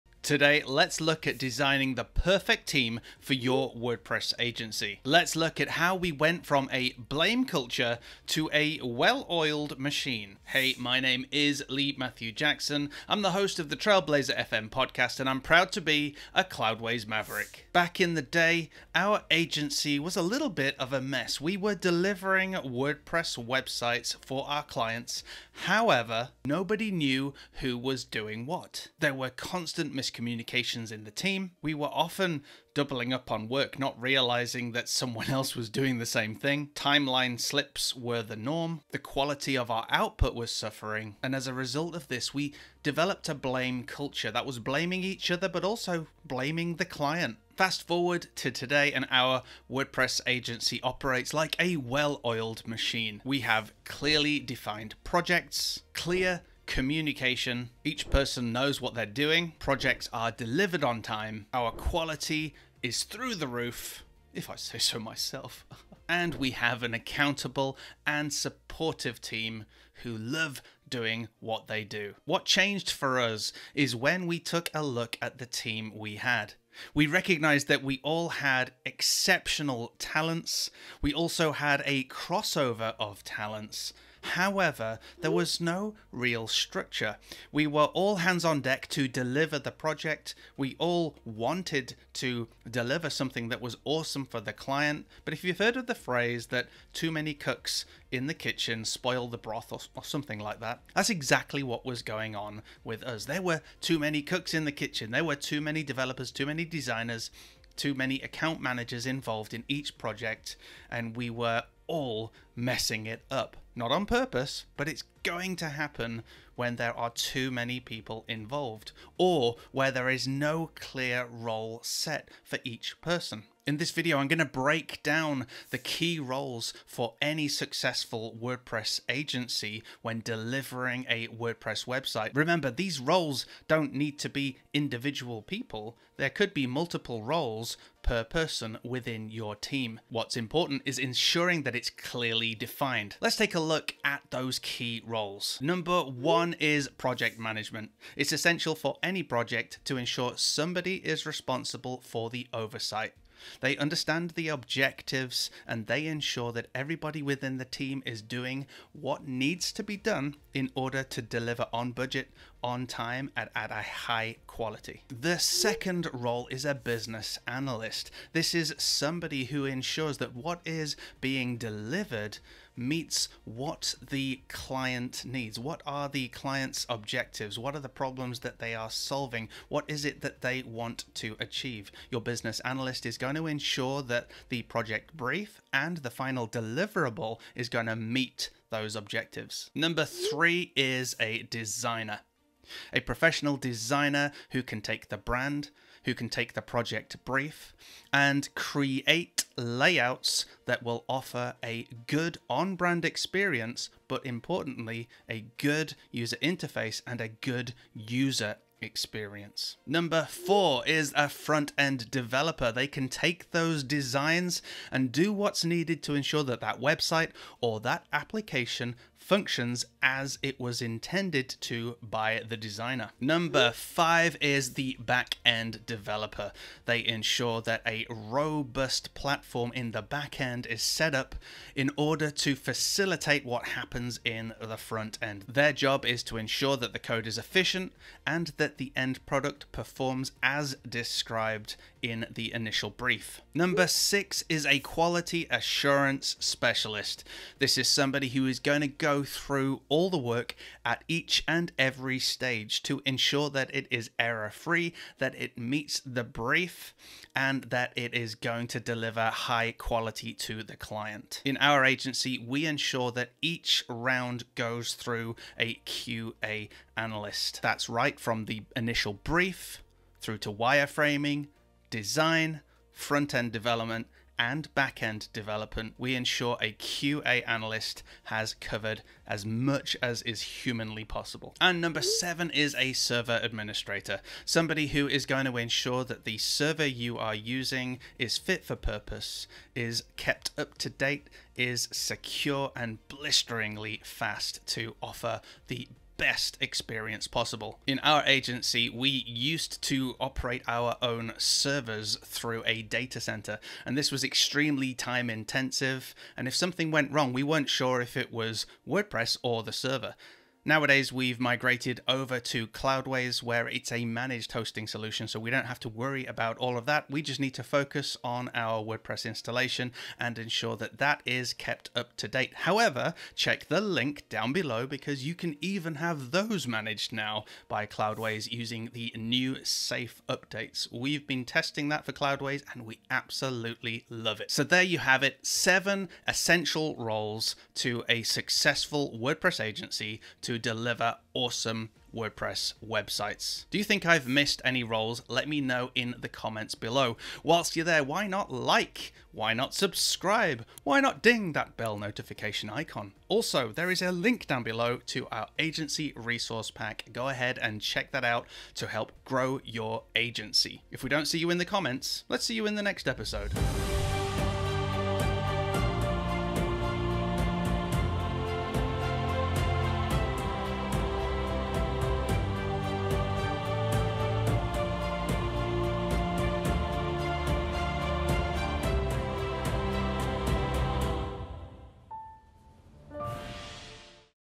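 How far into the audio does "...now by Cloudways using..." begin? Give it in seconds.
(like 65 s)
327 s.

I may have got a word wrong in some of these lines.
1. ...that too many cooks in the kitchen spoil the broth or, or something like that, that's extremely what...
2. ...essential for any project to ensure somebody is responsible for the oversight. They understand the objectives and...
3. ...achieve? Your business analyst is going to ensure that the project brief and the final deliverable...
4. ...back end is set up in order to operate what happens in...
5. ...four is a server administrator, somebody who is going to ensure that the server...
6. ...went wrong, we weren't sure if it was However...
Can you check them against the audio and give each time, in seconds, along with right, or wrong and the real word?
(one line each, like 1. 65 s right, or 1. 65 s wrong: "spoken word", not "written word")
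1. 96 s wrong: "exactly", not "extremely"
2. 148 s right
3. 181 s right
4. 230 s wrong: "facilitate", not "operate"
5. 282 s wrong: "seven", not "four"
6. 306 s wrong: "WordPress", not "However".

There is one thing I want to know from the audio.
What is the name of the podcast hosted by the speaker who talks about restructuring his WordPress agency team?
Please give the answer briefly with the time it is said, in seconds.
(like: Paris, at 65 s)
Trailblazer FM, at 13 s.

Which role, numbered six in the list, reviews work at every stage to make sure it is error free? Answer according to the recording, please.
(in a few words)
Quality assurance specialist.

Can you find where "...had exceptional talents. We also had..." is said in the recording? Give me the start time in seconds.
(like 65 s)
78 s.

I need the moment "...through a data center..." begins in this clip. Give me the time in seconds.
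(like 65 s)
302 s.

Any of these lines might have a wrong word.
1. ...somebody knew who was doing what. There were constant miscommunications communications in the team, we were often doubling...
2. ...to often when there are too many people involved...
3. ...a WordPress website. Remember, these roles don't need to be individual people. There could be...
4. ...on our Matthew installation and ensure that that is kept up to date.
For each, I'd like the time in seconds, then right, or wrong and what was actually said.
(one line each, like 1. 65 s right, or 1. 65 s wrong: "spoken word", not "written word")
1. 26 s wrong: "nobody", not "somebody"
2. 115 s wrong: "happen", not "often"
3. 131 s right
4. 318 s wrong: "WordPress", not "Matthew".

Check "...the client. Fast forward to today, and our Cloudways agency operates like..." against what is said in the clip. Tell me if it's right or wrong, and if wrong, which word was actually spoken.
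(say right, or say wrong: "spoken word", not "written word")
wrong: "WordPress", not "Cloudways".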